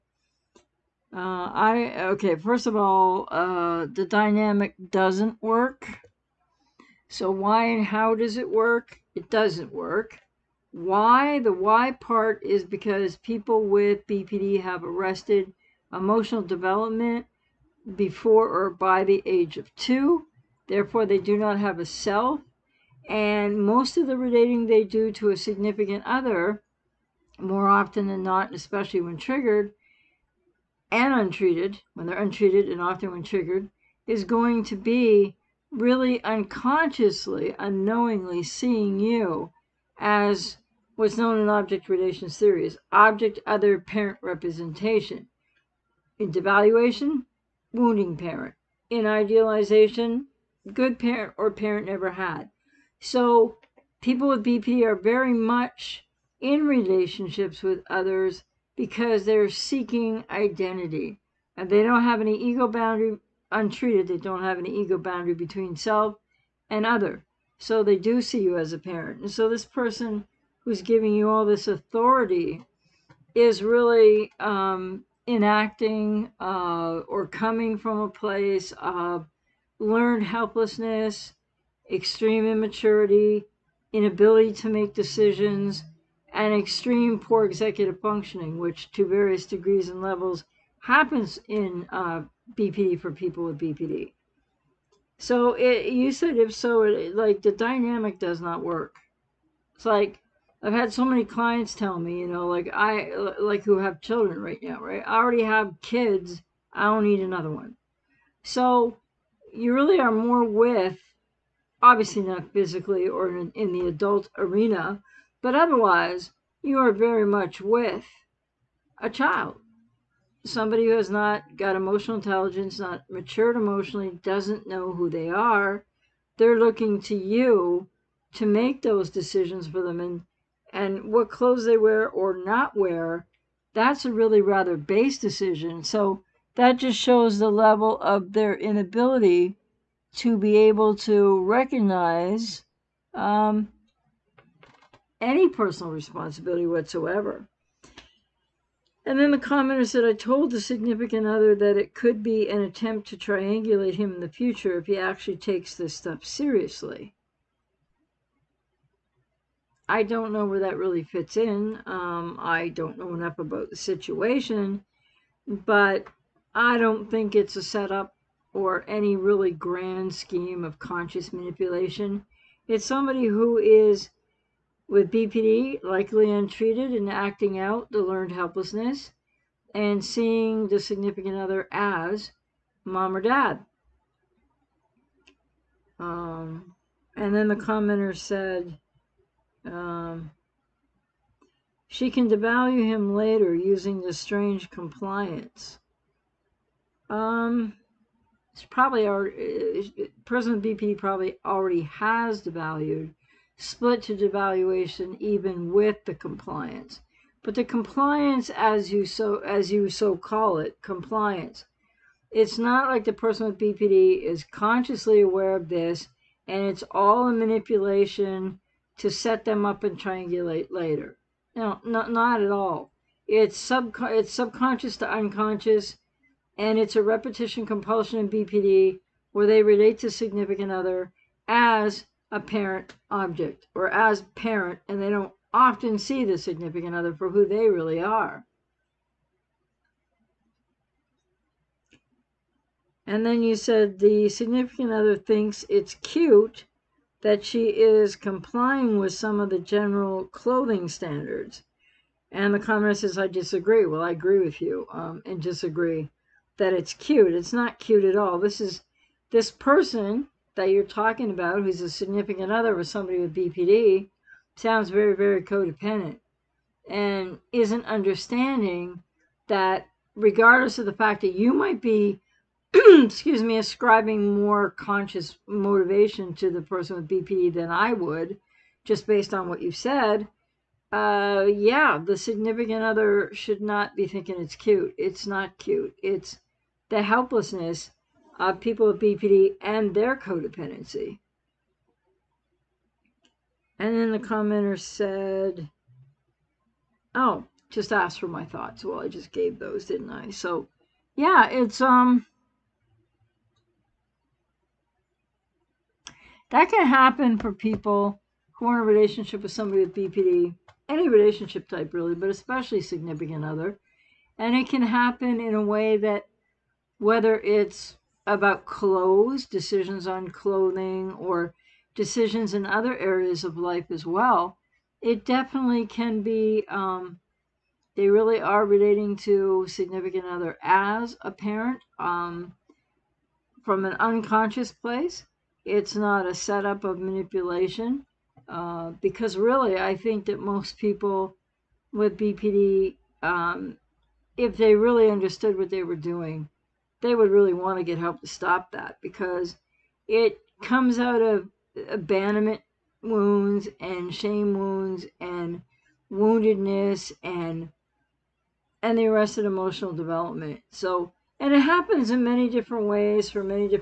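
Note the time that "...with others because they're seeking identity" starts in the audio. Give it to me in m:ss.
0:57.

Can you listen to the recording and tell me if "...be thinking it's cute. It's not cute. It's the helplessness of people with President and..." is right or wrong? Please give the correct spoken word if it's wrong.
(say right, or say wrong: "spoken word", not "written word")
wrong: "BPD", not "President".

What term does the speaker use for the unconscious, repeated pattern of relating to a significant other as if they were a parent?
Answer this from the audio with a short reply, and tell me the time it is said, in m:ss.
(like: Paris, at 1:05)
repetition compulsion, at 3:47.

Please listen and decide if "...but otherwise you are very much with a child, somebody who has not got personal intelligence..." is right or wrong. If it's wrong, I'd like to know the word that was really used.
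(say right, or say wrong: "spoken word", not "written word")
wrong: "emotional", not "personal".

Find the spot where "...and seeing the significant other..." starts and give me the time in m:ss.
2:59.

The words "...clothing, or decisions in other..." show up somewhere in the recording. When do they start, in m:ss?
5:20.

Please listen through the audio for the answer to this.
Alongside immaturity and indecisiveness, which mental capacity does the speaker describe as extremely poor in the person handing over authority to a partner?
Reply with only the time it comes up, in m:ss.
1:27.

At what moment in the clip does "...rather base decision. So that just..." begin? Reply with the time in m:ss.
2:14.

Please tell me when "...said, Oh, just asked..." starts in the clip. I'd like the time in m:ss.
4:54.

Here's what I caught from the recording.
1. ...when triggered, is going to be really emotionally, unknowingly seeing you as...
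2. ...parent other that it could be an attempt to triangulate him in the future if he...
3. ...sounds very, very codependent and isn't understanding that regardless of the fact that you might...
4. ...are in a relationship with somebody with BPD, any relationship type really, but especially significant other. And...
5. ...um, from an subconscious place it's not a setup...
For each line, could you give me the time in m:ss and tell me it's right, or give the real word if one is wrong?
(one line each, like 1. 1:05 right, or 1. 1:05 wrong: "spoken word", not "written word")
1. 0:33 wrong: "unconsciously", not "emotionally"
2. 2:30 wrong: "significant", not "parent"
3. 4:24 right
4. 5:08 right
5. 5:31 wrong: "unconscious", not "subconscious".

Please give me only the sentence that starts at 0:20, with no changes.
Therefore, they do not have a self.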